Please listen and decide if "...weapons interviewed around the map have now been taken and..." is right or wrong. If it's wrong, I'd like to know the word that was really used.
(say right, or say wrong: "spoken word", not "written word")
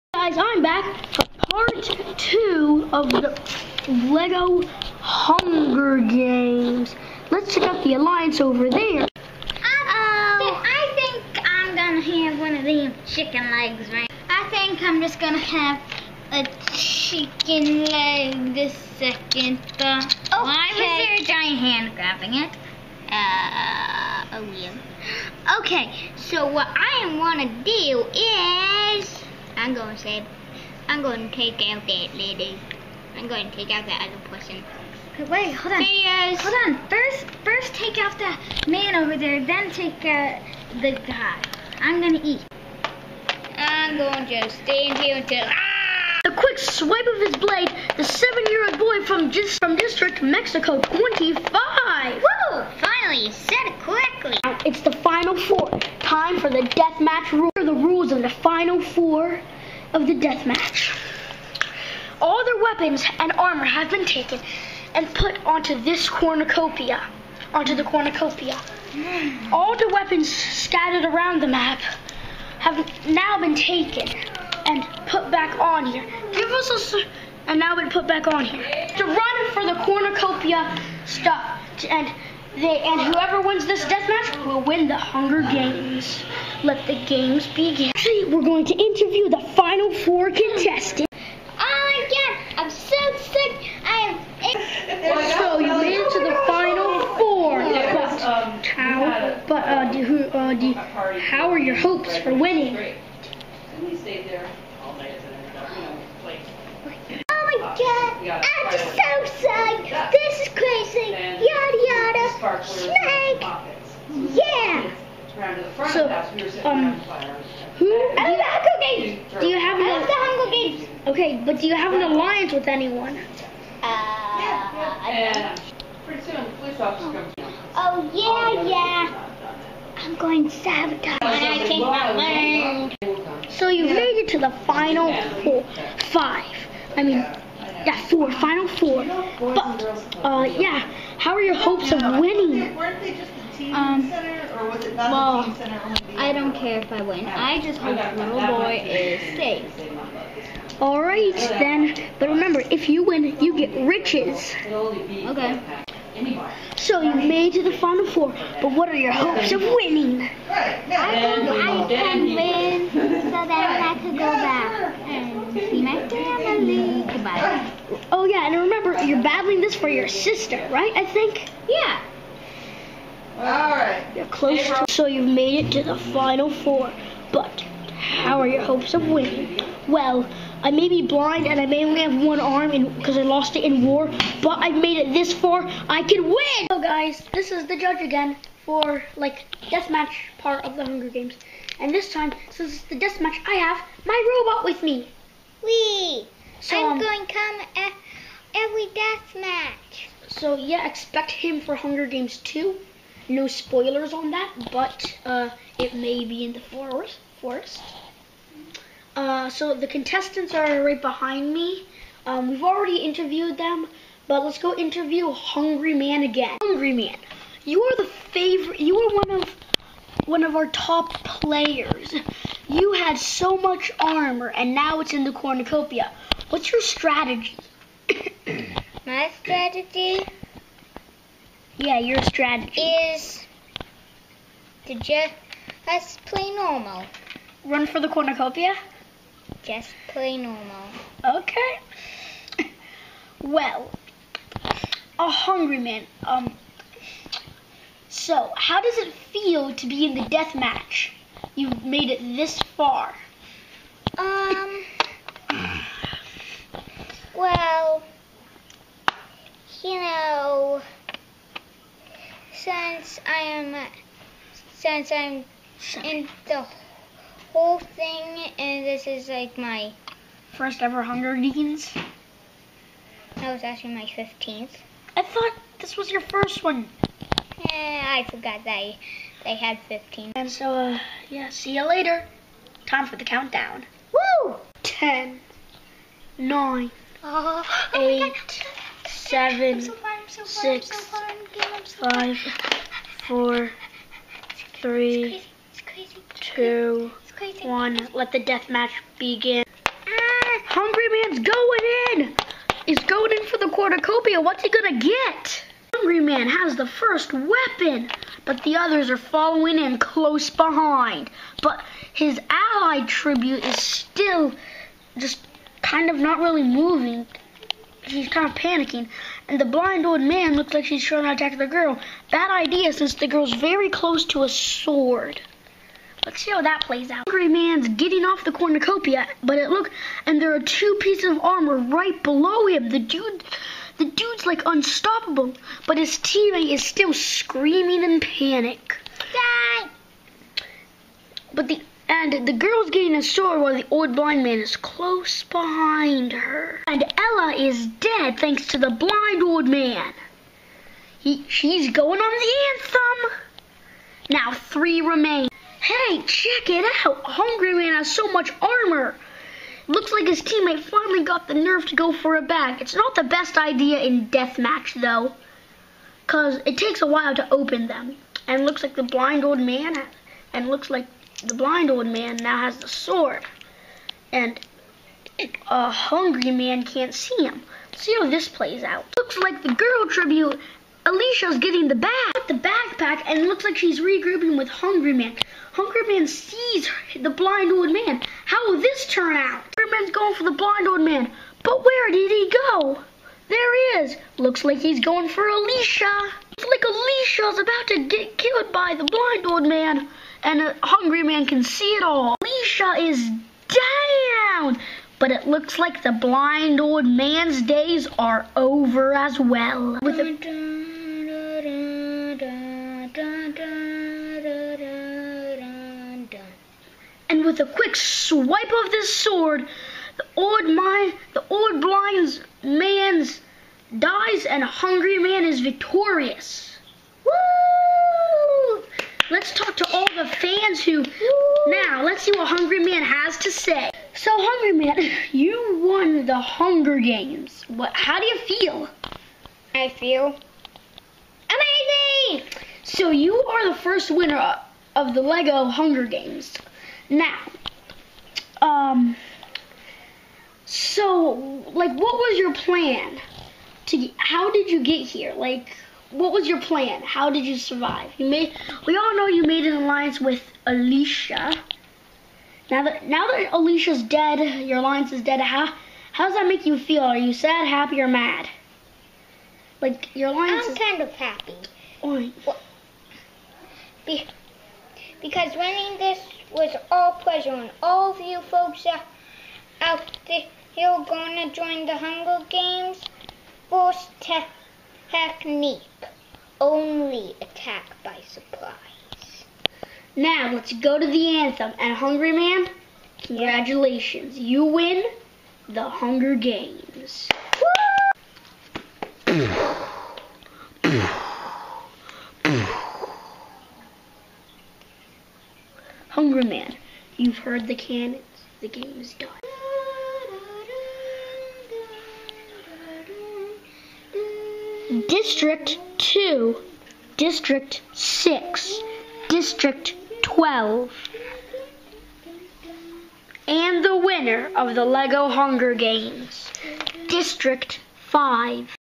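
wrong: "scattered", not "interviewed".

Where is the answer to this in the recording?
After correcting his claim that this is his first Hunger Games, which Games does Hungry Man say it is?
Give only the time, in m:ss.
4:34.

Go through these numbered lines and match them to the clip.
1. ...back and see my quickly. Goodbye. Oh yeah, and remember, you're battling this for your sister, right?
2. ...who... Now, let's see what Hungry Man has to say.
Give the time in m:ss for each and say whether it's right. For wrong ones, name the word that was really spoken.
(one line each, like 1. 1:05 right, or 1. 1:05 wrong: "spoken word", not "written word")
1. 2:44 wrong: "family", not "quickly"
2. 7:10 right.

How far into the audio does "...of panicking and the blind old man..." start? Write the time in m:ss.
5:18.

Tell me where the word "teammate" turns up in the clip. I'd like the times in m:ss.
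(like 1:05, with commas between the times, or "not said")
5:36, 6:00.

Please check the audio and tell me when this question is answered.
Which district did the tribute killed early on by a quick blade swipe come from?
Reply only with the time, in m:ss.
0:49.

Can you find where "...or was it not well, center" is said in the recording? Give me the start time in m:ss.
2:24.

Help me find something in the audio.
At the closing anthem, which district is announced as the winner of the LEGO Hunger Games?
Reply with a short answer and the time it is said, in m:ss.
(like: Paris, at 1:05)
District 5, at 8:47.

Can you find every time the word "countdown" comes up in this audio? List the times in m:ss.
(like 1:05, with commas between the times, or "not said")
4:43.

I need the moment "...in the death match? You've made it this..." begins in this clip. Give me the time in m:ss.
4:10.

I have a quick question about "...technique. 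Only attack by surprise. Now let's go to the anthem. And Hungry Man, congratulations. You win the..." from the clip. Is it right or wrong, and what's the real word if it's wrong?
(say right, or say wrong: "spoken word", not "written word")
right.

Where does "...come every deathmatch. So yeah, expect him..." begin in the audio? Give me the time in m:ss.
3:17.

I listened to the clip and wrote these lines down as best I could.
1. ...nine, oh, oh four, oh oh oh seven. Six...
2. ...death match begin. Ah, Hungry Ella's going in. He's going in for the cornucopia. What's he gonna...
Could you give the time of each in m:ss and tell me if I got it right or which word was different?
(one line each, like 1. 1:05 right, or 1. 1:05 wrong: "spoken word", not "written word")
1. 4:46 wrong: "eight", not "four"
2. 4:58 wrong: "Man", not "Ella".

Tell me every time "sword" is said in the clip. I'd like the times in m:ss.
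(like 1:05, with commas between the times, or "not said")
5:24, 5:43, 6:12, 6:59.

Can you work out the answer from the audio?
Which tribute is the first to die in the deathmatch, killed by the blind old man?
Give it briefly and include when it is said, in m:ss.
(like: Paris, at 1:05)
Ella, at 5:47.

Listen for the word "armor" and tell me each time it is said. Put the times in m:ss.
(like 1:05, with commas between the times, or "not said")
1:03, 3:43, 5:31, 5:58.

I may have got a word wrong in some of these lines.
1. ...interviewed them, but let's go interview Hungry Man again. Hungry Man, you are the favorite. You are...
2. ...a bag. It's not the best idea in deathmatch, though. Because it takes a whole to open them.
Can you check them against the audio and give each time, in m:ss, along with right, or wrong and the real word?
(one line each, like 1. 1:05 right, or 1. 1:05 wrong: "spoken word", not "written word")
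1. 3:32 right
2. 6:02 wrong: "while", not "whole".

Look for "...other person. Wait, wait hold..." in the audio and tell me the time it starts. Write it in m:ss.
0:34.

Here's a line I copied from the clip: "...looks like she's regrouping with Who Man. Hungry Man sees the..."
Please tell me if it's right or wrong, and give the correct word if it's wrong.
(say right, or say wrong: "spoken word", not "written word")
wrong: "Hungry", not "Who".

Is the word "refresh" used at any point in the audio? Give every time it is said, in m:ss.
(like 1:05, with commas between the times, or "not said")
not said.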